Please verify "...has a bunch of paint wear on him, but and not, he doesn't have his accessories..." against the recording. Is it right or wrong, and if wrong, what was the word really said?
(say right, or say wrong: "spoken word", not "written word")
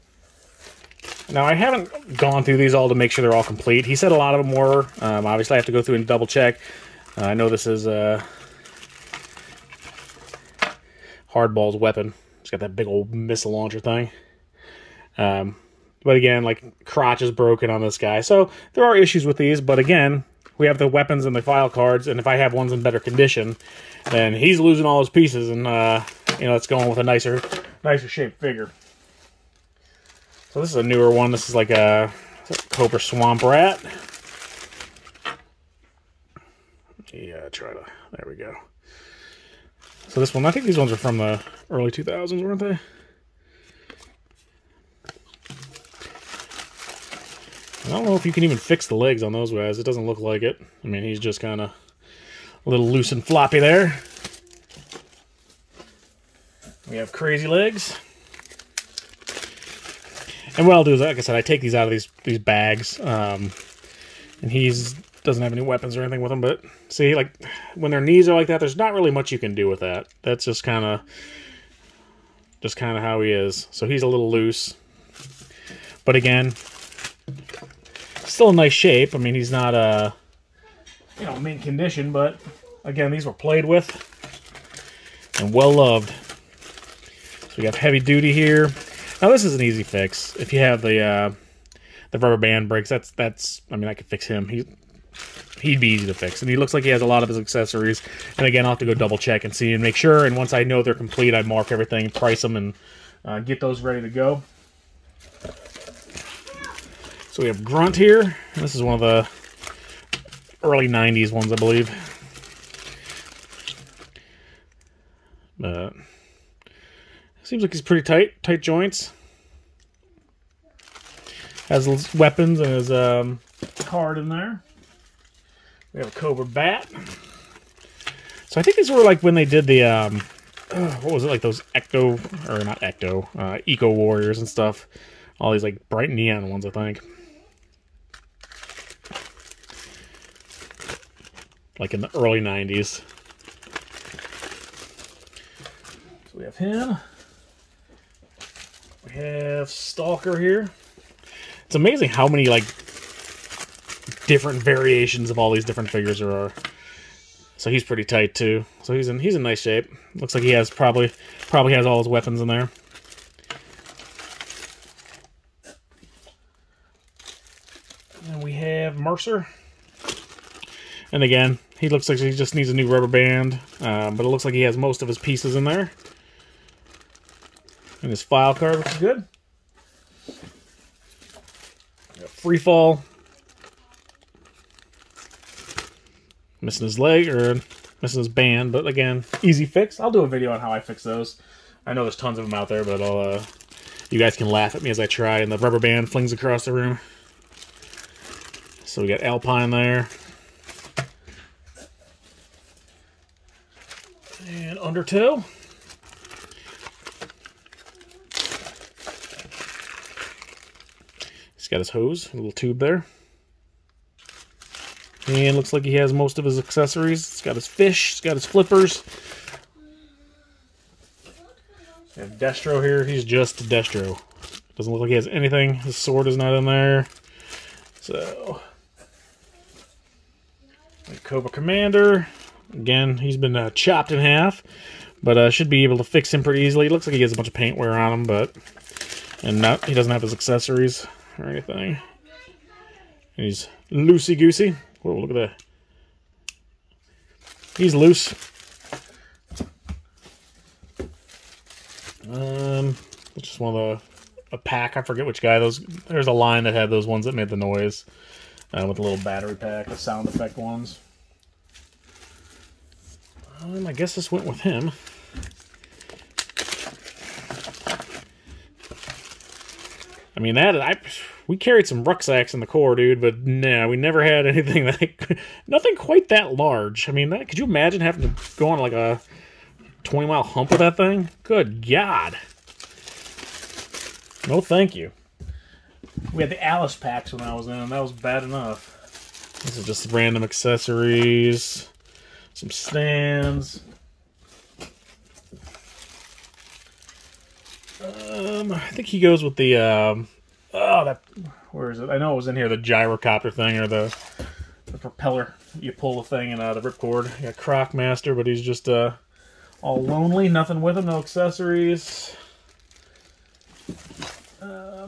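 right.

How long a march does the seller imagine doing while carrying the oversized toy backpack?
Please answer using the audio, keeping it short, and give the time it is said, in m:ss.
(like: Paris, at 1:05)
20 miles, at 4:40.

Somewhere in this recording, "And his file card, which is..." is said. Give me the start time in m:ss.
2:58.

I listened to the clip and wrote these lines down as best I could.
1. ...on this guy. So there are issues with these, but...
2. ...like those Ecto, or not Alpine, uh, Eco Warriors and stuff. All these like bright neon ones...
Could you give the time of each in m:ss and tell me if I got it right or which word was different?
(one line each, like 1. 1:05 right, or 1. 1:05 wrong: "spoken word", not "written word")
1. 0:17 right
2. 2:11 wrong: "Ecto", not "Alpine".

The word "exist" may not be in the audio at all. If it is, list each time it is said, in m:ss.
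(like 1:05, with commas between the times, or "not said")
not said.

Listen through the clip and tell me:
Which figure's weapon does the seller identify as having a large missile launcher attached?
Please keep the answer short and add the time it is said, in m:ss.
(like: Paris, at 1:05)
Hardball, at 0:11.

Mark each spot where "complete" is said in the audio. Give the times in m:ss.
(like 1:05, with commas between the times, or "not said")
0:03, 1:40.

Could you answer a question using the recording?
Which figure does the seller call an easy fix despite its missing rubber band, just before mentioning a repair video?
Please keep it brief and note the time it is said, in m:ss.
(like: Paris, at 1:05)
Free fall, at 3:02.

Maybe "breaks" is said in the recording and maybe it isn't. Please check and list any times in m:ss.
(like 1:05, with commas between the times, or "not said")
1:32.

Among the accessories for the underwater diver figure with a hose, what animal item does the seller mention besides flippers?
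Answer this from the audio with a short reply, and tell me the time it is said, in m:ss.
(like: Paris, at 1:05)
fish, at 3:37.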